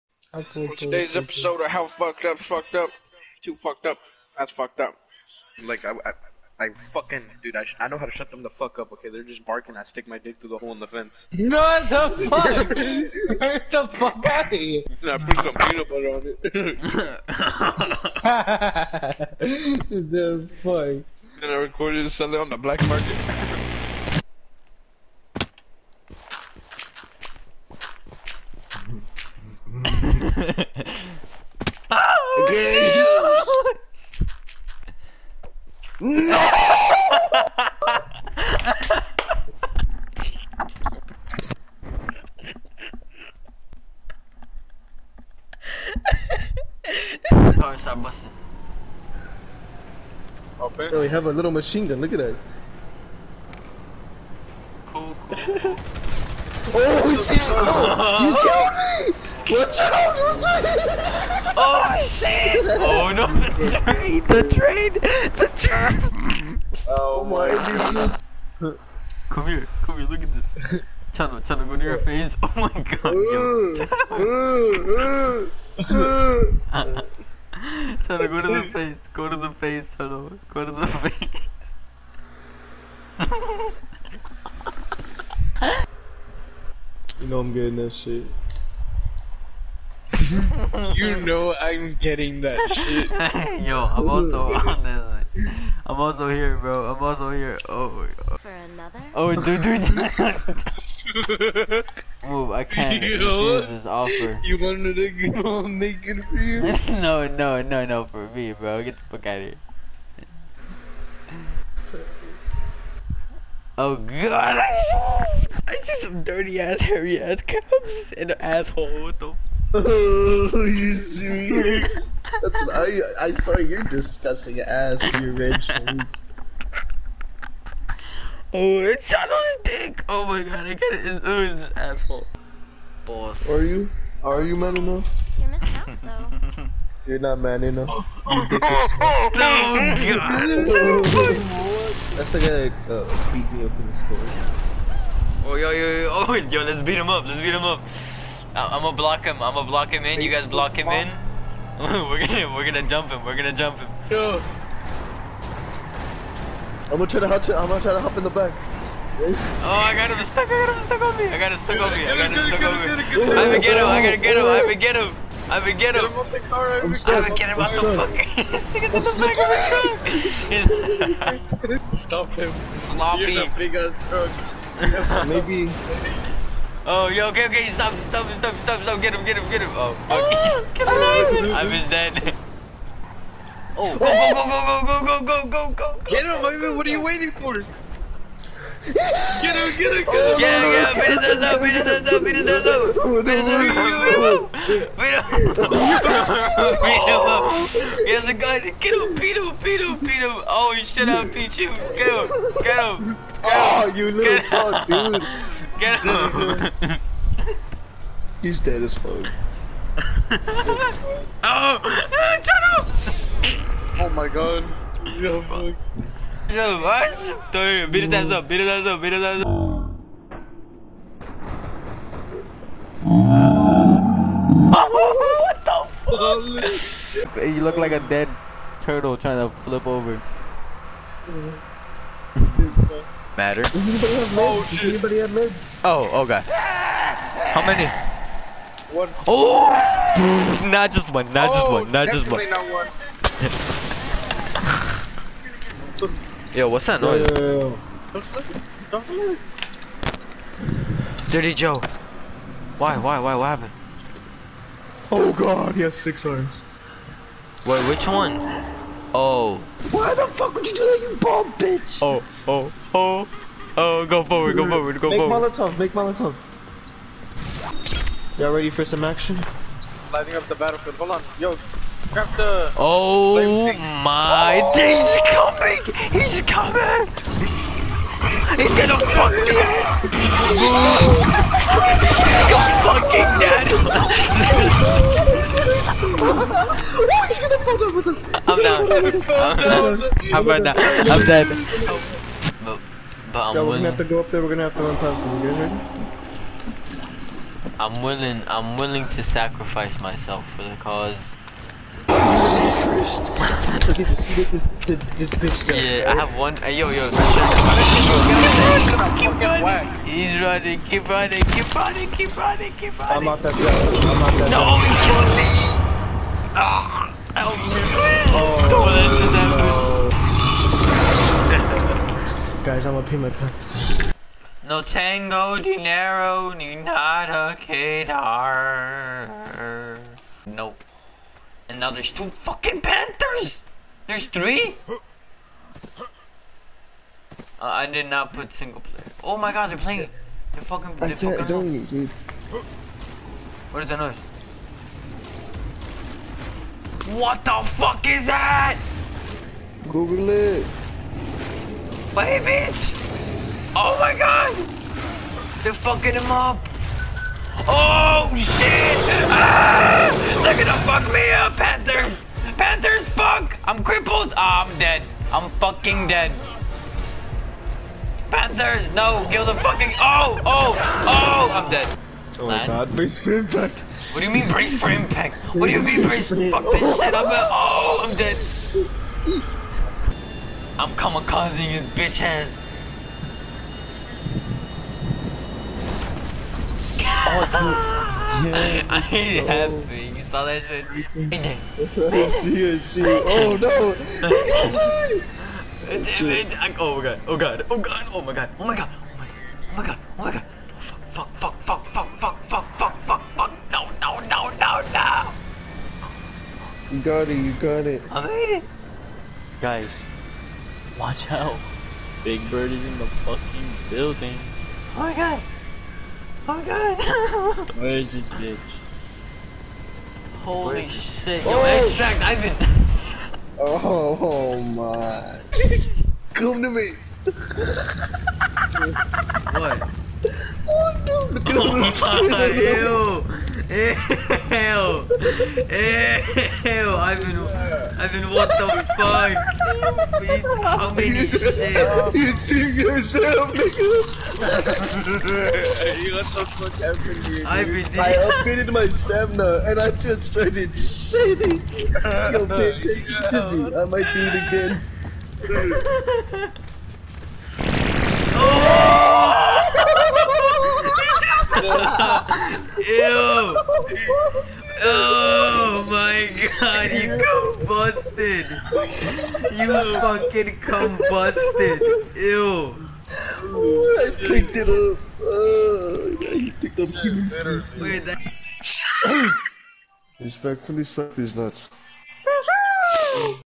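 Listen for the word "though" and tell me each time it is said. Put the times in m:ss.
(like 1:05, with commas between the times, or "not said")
2:16.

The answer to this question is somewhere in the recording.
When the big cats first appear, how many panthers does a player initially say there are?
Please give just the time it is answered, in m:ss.
5:32.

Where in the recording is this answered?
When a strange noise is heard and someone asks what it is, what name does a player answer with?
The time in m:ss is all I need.
4:11.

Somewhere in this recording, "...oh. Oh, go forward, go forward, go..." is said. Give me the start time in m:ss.
4:22.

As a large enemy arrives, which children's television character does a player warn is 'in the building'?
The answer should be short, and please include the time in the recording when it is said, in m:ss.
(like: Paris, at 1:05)
Big Bird, at 6:52.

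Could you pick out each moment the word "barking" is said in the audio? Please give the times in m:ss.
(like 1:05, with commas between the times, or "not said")
0:09.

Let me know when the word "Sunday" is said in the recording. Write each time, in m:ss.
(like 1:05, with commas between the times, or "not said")
0:22.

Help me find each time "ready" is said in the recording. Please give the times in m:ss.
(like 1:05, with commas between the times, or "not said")
4:28, 4:55.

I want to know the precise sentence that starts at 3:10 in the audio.
Yeah, yeah, beat his ass up, beat his ass up, beat his ass up.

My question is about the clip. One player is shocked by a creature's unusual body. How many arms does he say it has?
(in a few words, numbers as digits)
6.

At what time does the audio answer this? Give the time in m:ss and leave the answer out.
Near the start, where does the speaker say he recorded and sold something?
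0:22.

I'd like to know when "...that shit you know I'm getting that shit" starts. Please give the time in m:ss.
1:27.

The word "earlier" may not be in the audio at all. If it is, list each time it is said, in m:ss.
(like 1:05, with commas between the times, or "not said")
not said.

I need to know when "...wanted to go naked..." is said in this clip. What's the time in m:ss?
1:44.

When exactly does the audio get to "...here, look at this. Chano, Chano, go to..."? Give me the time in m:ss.
1:09.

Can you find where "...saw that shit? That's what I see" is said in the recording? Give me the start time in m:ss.
6:30.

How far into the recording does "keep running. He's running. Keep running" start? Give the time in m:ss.
5:09.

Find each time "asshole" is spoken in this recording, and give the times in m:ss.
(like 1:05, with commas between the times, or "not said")
1:58, 2:11.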